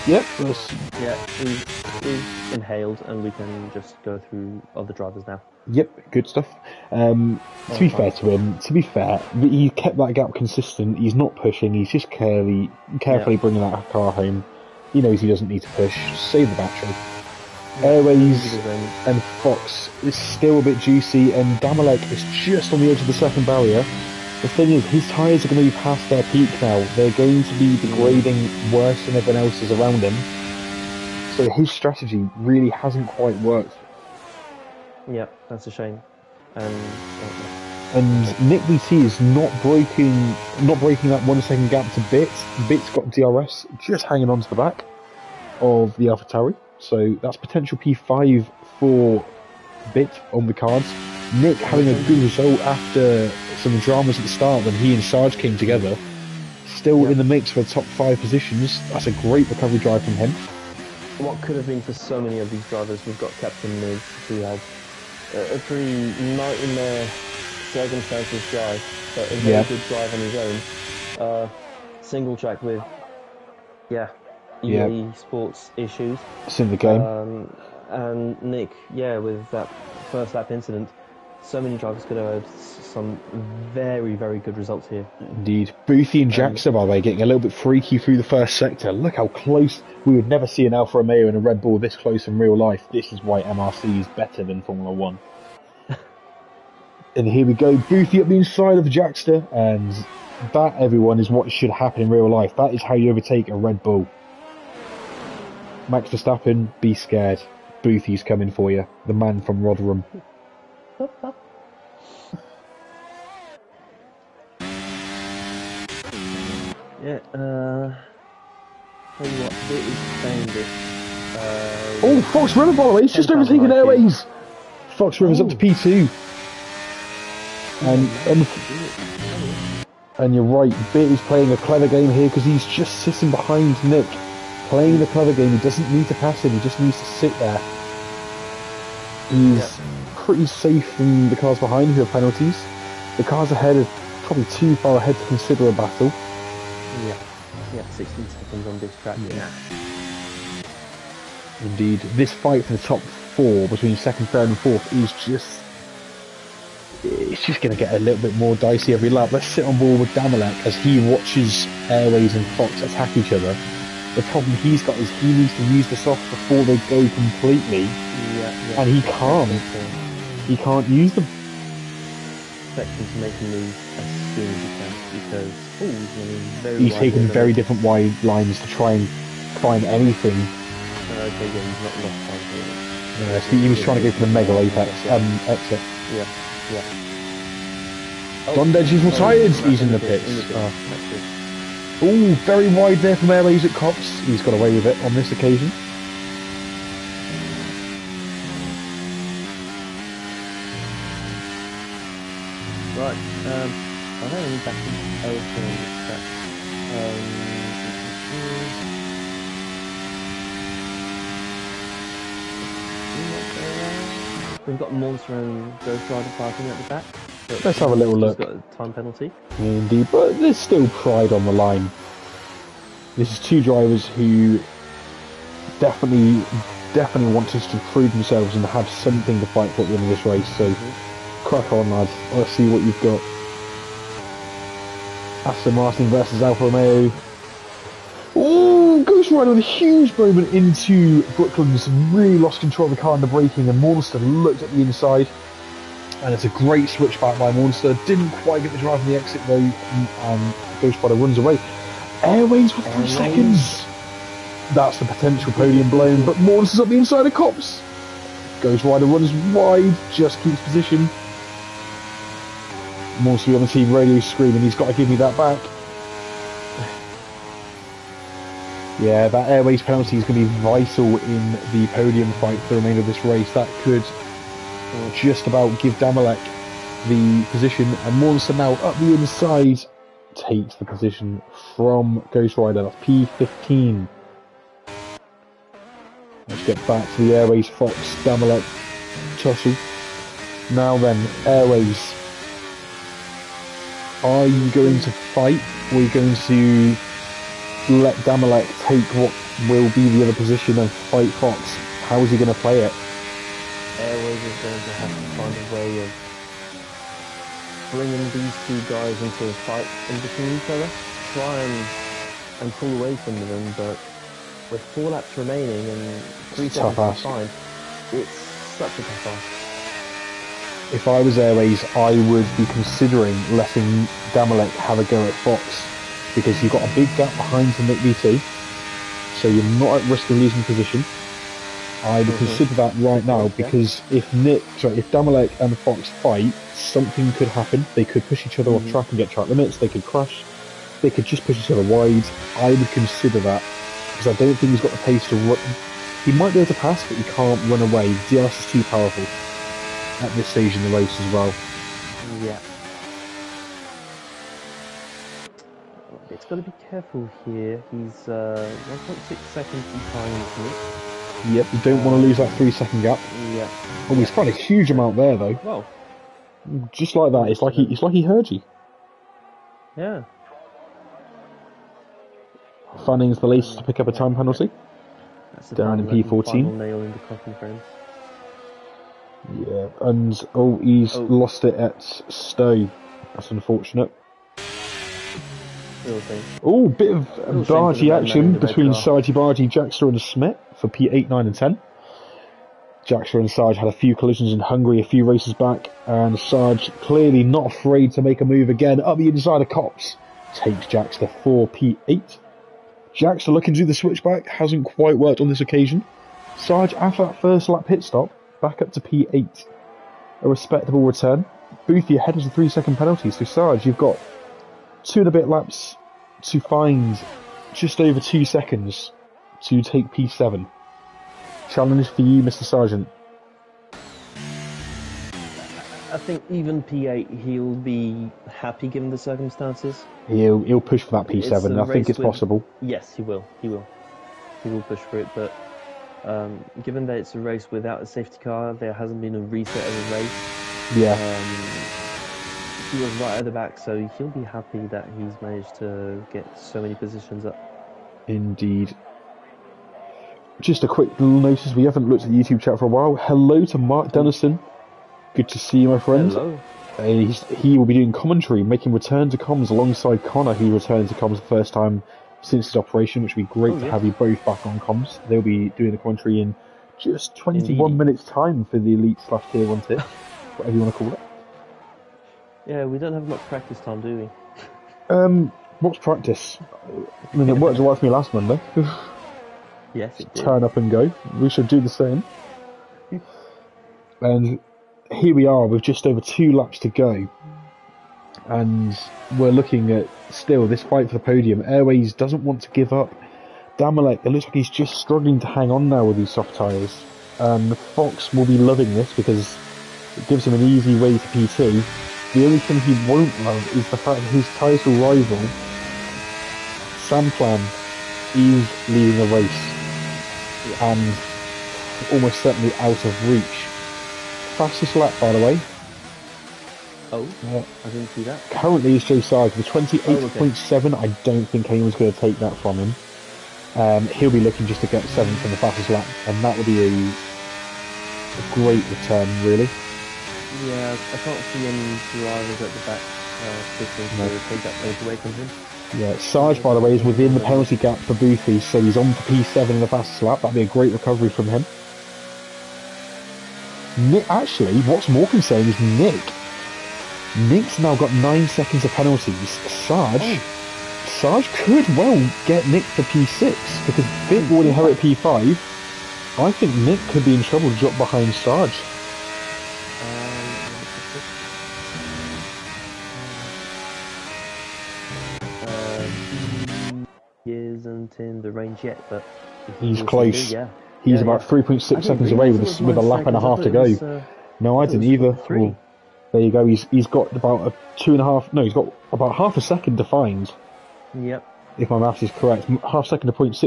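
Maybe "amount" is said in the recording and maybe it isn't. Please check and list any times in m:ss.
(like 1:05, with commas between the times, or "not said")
6:04.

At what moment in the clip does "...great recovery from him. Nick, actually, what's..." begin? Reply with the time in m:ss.
9:00.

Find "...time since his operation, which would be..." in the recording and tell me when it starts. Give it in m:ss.
7:41.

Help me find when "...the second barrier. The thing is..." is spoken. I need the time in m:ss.
0:23.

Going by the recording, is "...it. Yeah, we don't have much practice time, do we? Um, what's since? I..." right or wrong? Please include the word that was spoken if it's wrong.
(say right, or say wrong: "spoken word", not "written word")
wrong: "practice", not "since".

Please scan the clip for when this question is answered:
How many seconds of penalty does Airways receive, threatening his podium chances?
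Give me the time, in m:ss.
4:12.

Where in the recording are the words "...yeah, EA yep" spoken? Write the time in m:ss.
1:13.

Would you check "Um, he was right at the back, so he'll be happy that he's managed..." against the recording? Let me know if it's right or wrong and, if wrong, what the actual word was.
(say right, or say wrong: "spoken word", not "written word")
right.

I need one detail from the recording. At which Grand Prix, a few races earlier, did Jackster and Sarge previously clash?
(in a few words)
Hungary.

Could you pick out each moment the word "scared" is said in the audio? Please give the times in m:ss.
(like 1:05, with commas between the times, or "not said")
1:46.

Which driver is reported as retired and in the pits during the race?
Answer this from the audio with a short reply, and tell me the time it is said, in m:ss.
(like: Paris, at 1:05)
Don Deji, at 3:08.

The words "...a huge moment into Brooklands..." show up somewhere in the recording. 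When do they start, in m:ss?
3:59.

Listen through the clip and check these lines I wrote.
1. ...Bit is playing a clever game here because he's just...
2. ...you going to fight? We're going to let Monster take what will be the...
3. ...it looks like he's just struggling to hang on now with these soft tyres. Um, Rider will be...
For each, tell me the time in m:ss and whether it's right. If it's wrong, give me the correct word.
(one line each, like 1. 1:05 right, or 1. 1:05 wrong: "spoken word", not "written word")
1. 2:10 right
2. 4:54 wrong: "Damalek", not "Monster"
3. 8:14 wrong: "Fox", not "Rider".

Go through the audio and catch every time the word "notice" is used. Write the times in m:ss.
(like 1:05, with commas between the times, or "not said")
7:31.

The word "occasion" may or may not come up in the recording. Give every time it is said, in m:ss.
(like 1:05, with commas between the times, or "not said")
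3:15, 6:45.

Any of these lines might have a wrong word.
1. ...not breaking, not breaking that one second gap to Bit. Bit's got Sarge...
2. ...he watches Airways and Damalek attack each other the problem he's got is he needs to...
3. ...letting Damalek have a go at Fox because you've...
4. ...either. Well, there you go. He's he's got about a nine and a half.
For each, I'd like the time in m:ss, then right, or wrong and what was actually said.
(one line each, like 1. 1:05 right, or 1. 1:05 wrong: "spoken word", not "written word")
1. 0:39 wrong: "DRS", not "Sarge"
2. 2:40 wrong: "Fox", not "Damalek"
3. 5:23 right
4. 9:35 wrong: "two", not "nine".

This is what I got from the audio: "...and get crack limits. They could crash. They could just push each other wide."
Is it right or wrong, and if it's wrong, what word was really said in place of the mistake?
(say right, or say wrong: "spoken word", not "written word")
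wrong: "track", not "crack".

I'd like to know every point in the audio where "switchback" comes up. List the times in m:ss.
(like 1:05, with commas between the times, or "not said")
4:06, 6:43.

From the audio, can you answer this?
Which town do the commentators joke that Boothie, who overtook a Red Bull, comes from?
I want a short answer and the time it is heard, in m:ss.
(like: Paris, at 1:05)
Rotherham, at 1:49.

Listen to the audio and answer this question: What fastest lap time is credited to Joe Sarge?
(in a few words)
28.7.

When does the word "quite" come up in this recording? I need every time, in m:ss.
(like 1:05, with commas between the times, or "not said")
0:33, 4:08, 6:44.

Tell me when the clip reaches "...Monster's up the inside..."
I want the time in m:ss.
4:16.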